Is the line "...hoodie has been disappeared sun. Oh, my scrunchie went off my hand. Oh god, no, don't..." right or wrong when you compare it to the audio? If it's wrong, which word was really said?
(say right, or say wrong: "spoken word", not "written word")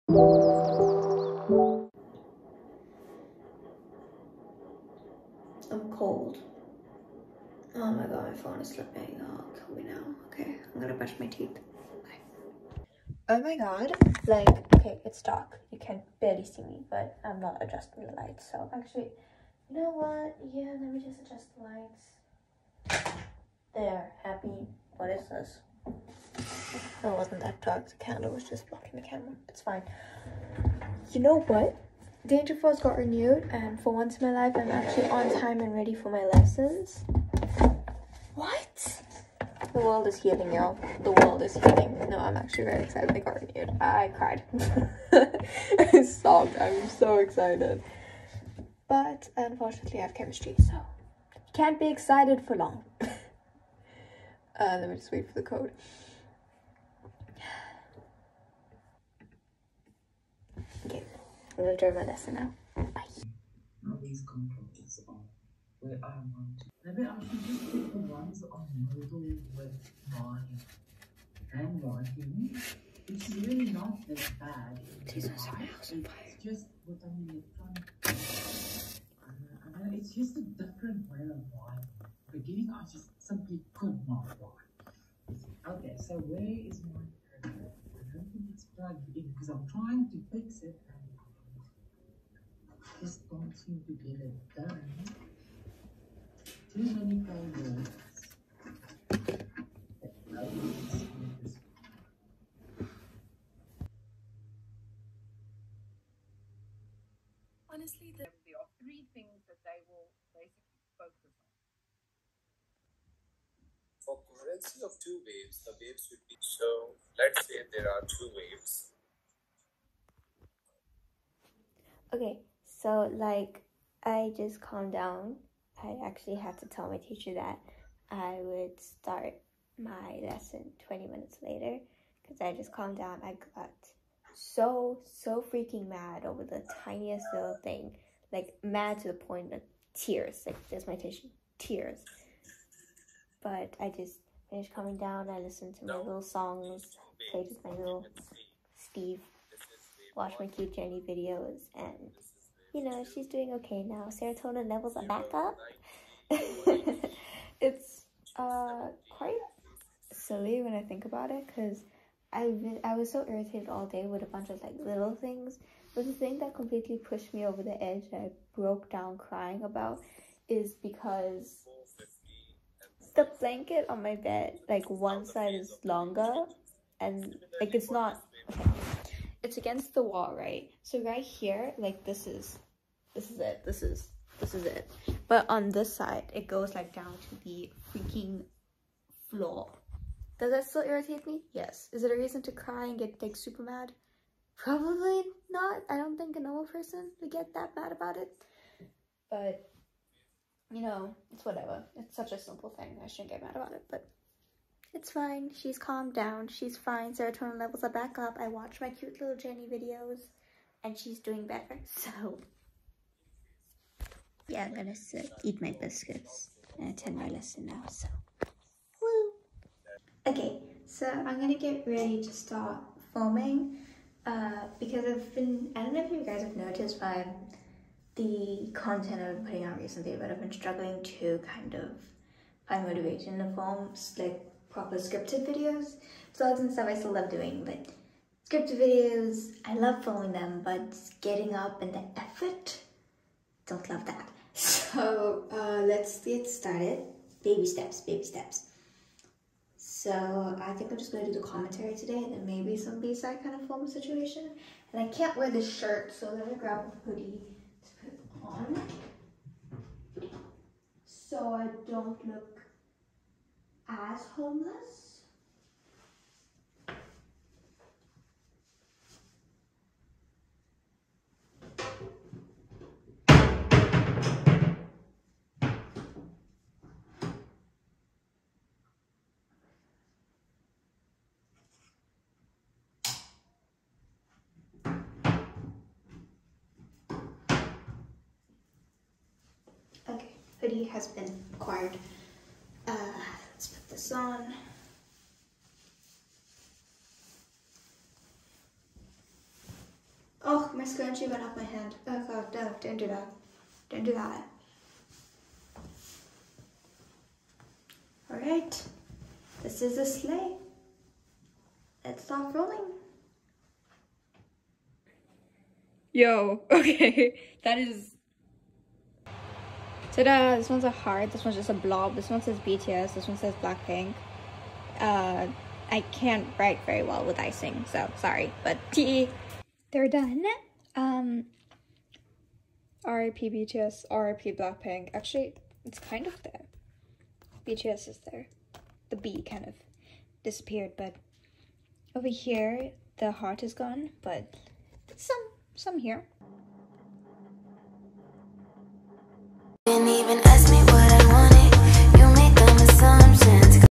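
wrong: "acquired", not "disappeared".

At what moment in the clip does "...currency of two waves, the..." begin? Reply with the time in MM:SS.
01:54.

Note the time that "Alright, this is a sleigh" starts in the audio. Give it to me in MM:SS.
05:08.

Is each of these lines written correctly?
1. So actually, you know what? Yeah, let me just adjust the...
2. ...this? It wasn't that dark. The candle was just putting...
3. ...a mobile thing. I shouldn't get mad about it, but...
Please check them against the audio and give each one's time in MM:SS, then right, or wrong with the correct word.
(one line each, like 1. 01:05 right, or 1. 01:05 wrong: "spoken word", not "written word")
1. 00:18 right
2. 00:25 wrong: "blocking", not "putting"
3. 03:22 wrong: "simple", not "mobile".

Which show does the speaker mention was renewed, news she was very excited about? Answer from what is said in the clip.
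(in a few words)
Danger Force.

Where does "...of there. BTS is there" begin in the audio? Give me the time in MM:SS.
05:36.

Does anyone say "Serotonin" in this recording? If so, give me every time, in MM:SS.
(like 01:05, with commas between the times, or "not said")
02:34, 03:27.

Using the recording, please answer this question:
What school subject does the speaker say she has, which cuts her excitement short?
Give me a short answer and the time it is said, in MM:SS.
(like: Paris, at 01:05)
Chemistry, at 00:50.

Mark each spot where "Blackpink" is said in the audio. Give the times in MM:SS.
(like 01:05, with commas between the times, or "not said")
05:23, 05:34.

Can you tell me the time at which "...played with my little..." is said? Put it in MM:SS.
02:27.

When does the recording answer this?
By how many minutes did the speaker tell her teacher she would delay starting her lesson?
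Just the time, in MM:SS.
02:10.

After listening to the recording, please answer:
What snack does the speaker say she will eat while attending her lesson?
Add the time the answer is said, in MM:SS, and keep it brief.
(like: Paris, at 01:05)
Biscuits, at 03:35.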